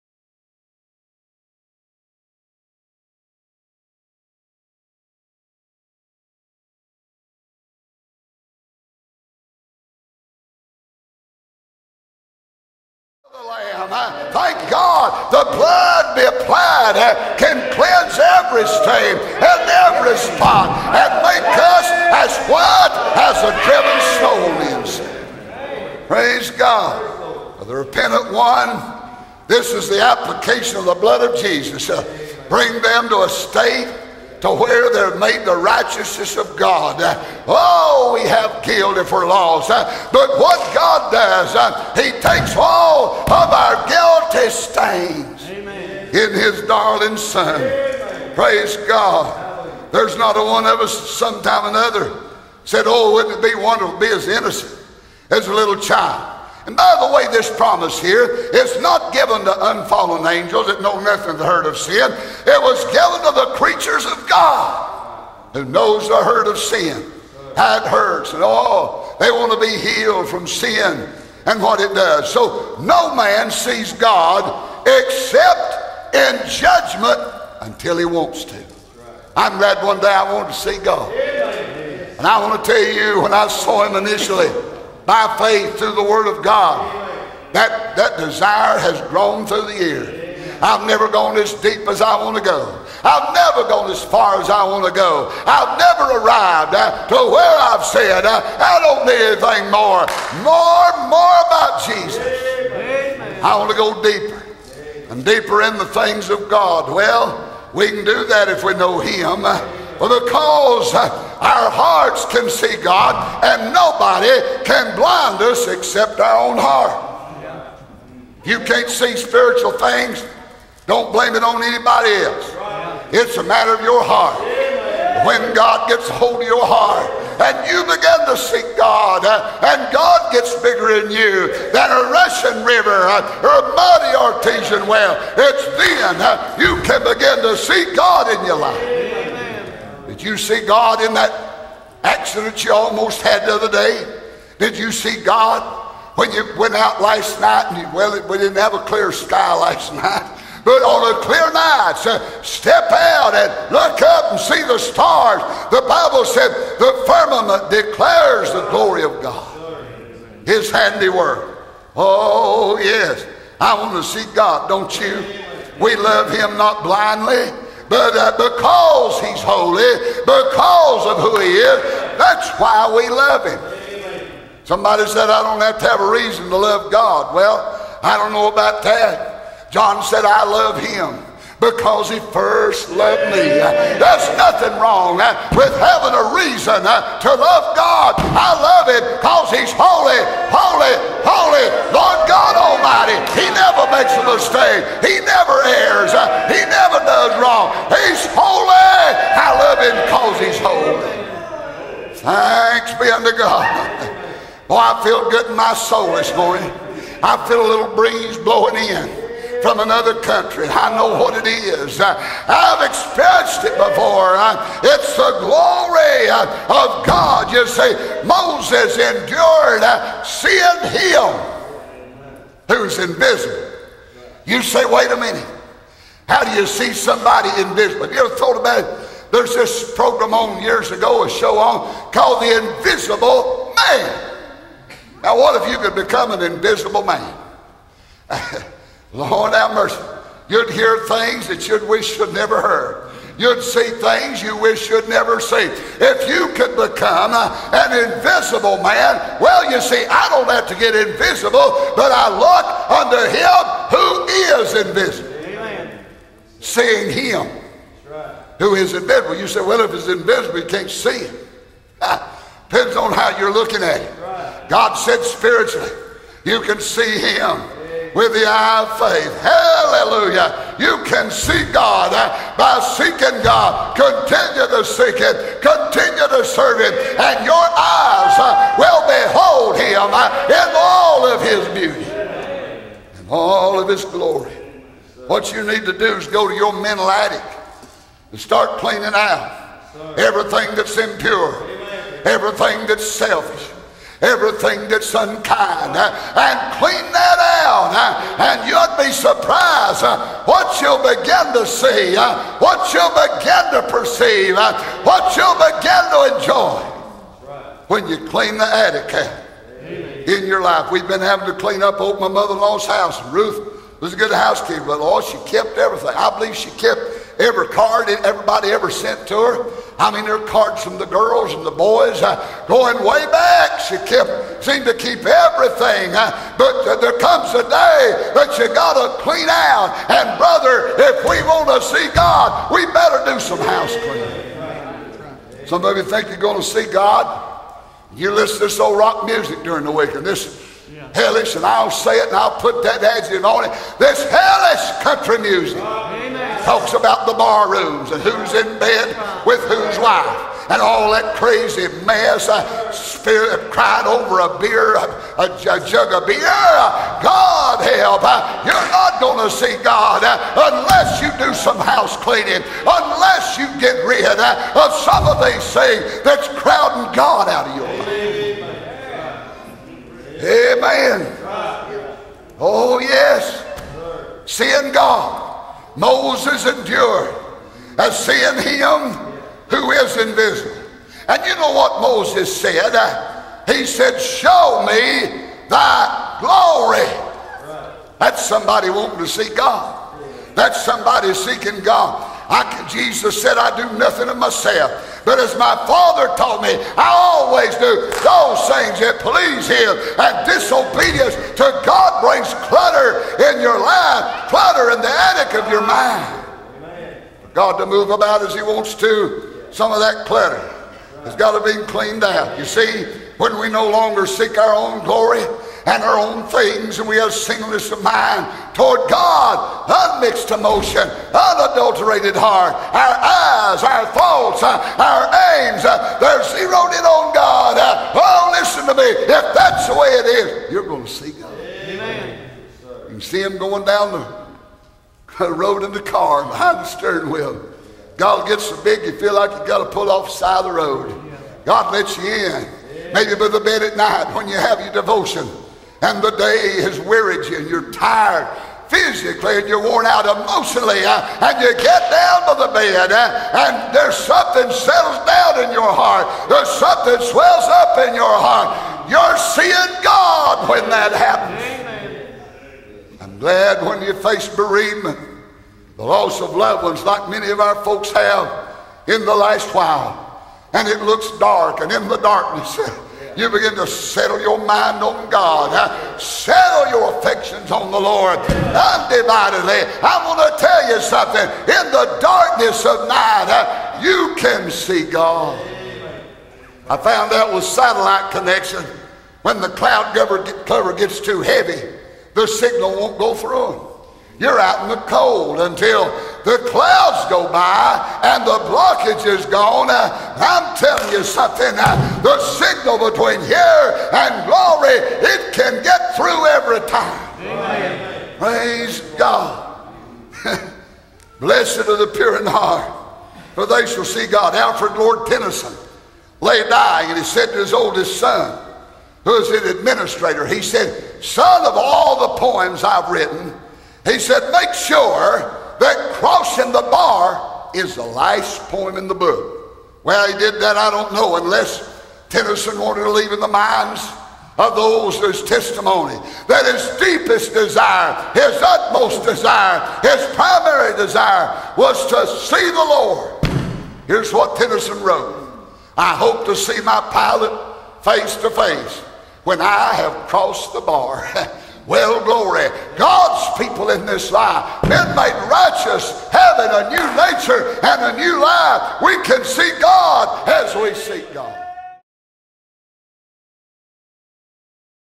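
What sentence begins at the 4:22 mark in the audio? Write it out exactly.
Depends on how you're looking at it.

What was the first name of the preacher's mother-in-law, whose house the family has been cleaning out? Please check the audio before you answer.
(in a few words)
Ruth.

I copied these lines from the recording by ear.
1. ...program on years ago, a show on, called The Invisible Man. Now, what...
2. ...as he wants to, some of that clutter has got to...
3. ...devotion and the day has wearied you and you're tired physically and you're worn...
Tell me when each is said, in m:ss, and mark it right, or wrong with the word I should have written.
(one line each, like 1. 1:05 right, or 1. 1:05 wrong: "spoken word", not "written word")
1. 3:49 right
2. 6:48 right
3. 7:24 right.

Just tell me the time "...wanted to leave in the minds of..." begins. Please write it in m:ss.
8:52.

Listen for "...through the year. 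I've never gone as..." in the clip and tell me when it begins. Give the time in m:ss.
1:29.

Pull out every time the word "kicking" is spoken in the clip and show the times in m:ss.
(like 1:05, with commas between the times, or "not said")
not said.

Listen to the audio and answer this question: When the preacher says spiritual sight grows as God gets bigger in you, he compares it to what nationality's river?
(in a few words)
Russian.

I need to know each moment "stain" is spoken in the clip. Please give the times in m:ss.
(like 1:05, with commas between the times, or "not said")
0:18, 0:44.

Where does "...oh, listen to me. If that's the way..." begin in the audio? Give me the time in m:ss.
7:08.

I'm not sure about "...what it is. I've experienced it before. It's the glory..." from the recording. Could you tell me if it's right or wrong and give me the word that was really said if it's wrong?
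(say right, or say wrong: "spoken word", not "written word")
right.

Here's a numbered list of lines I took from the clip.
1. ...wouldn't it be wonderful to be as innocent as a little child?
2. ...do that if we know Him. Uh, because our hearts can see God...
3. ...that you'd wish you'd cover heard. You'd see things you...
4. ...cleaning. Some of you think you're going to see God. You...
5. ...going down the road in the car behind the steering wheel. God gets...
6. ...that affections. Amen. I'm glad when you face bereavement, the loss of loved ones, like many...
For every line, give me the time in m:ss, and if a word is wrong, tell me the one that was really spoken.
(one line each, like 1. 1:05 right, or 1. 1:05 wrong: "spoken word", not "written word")
1. 0:53 right
2. 1:48 right
3. 4:01 wrong: "never", not "cover"
4. 5:33 right
5. 7:13 right
6. 7:40 wrong: "happens", not "affections".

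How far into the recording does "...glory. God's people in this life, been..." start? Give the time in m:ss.
9:12.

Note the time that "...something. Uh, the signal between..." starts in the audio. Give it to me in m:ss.
8:21.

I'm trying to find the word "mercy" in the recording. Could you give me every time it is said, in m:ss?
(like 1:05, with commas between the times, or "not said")
3:59.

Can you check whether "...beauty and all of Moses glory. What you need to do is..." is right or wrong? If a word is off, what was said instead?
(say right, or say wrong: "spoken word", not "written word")
wrong: "His", not "Moses".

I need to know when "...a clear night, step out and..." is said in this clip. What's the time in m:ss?
2:31.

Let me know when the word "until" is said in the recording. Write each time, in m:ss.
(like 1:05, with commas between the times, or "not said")
1:17, 8:15.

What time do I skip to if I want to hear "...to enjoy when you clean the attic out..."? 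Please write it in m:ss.
5:06.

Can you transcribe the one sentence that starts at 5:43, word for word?
This hellish country music talks about the bar rooms and who's in bed with whose wife and all that crazy mess.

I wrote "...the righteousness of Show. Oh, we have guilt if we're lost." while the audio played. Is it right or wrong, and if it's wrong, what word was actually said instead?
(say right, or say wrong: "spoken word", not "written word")
wrong: "God", not "Show".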